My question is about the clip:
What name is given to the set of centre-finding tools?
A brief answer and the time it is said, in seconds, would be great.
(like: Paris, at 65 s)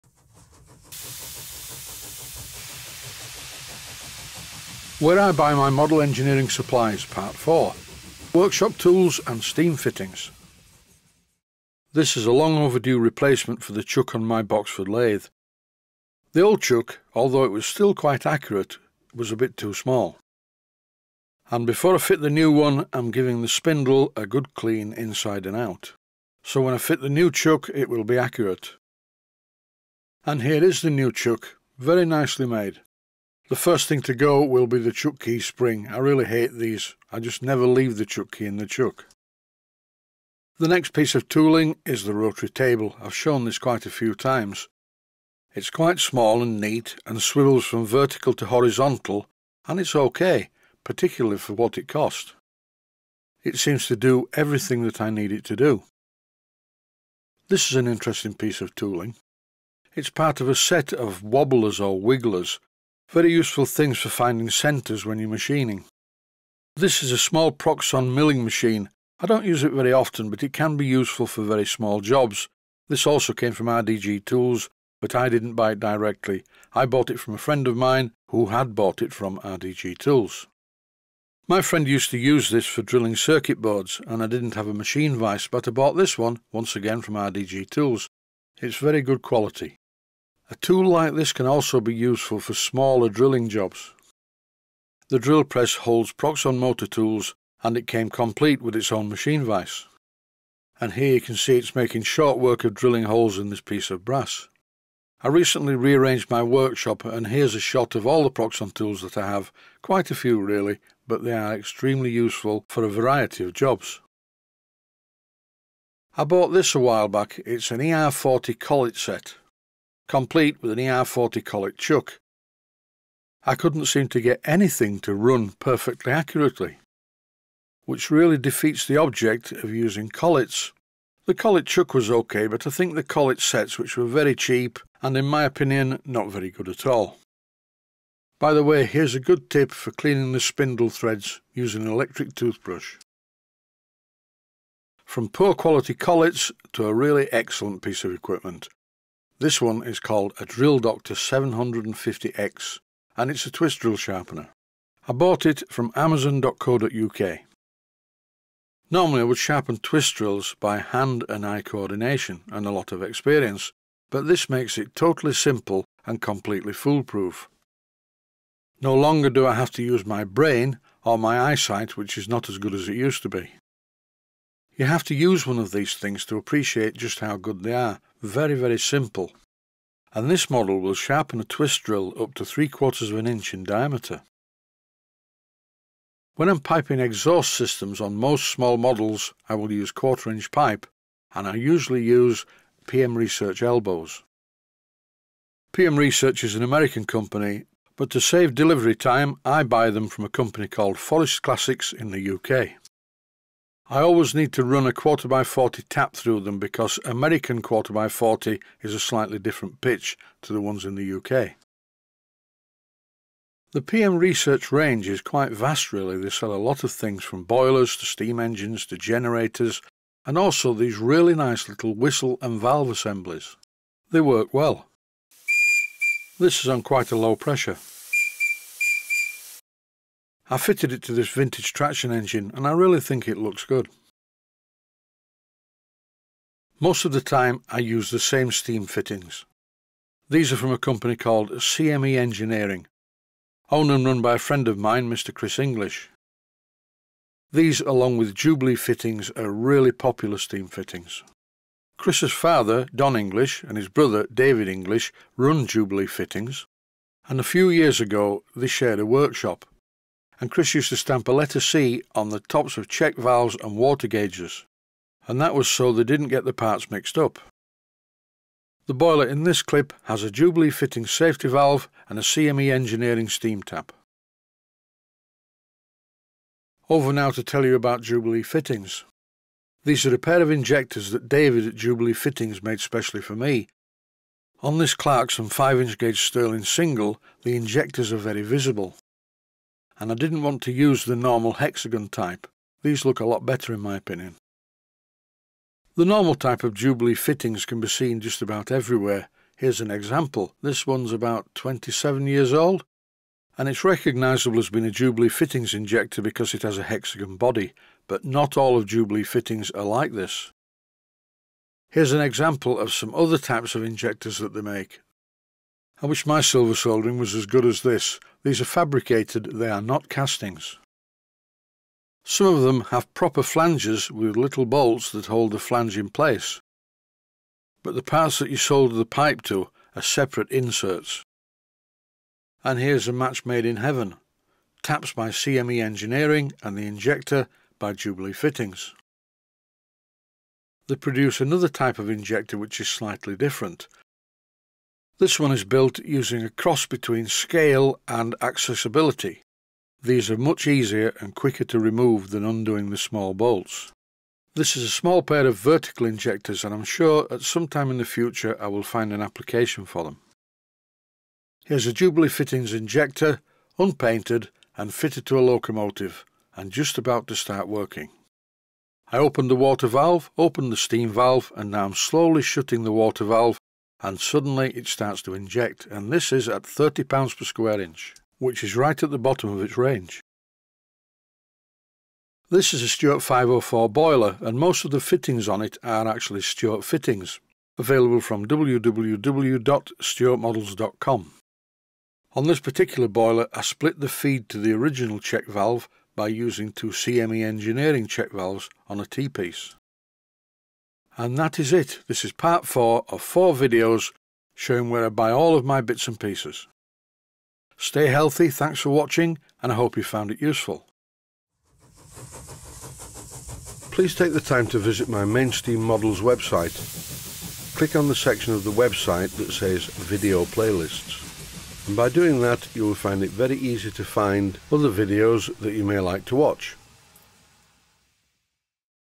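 wigglers, at 61 s.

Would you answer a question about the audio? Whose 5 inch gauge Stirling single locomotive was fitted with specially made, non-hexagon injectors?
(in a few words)
Clarkson.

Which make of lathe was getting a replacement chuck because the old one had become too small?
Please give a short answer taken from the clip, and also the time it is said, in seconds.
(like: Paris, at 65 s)
Boxford, at 14 s.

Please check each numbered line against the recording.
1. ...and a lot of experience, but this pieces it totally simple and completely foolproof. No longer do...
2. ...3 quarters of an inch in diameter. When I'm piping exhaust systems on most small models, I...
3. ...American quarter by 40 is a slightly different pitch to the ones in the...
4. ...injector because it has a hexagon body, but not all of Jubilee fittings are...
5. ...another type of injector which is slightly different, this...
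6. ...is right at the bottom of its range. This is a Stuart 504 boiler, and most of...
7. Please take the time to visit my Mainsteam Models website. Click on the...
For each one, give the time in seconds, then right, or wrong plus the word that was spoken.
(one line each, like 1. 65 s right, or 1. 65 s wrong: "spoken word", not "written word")
1. 162 s wrong: "makes", not "pieces"
2. 182 s right
3. 207 s right
4. 305 s right
5. 341 s right
6. 378 s right
7. 413 s right.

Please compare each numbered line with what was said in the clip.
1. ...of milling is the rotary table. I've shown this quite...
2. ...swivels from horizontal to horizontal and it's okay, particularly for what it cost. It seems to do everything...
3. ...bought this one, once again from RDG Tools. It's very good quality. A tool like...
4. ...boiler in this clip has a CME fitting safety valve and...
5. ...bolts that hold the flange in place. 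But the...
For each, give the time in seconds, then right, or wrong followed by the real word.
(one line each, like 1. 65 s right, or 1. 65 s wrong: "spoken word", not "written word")
1. 41 s wrong: "tooling", not "milling"
2. 47 s wrong: "vertical", not "horizontal"
3. 85 s right
4. 268 s wrong: "Jubilee", not "CME"
5. 324 s right.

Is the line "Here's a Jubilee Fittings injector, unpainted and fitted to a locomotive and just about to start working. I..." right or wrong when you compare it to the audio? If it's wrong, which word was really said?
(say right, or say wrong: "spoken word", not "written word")
right.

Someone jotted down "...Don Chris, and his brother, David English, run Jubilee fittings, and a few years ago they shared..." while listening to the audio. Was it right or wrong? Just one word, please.
wrong.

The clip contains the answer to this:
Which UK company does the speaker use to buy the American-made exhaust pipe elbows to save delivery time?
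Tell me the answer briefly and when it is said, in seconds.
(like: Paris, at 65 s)
Forest Classics, at 200 s.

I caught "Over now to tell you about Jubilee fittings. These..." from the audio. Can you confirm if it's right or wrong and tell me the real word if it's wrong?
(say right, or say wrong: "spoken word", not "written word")
right.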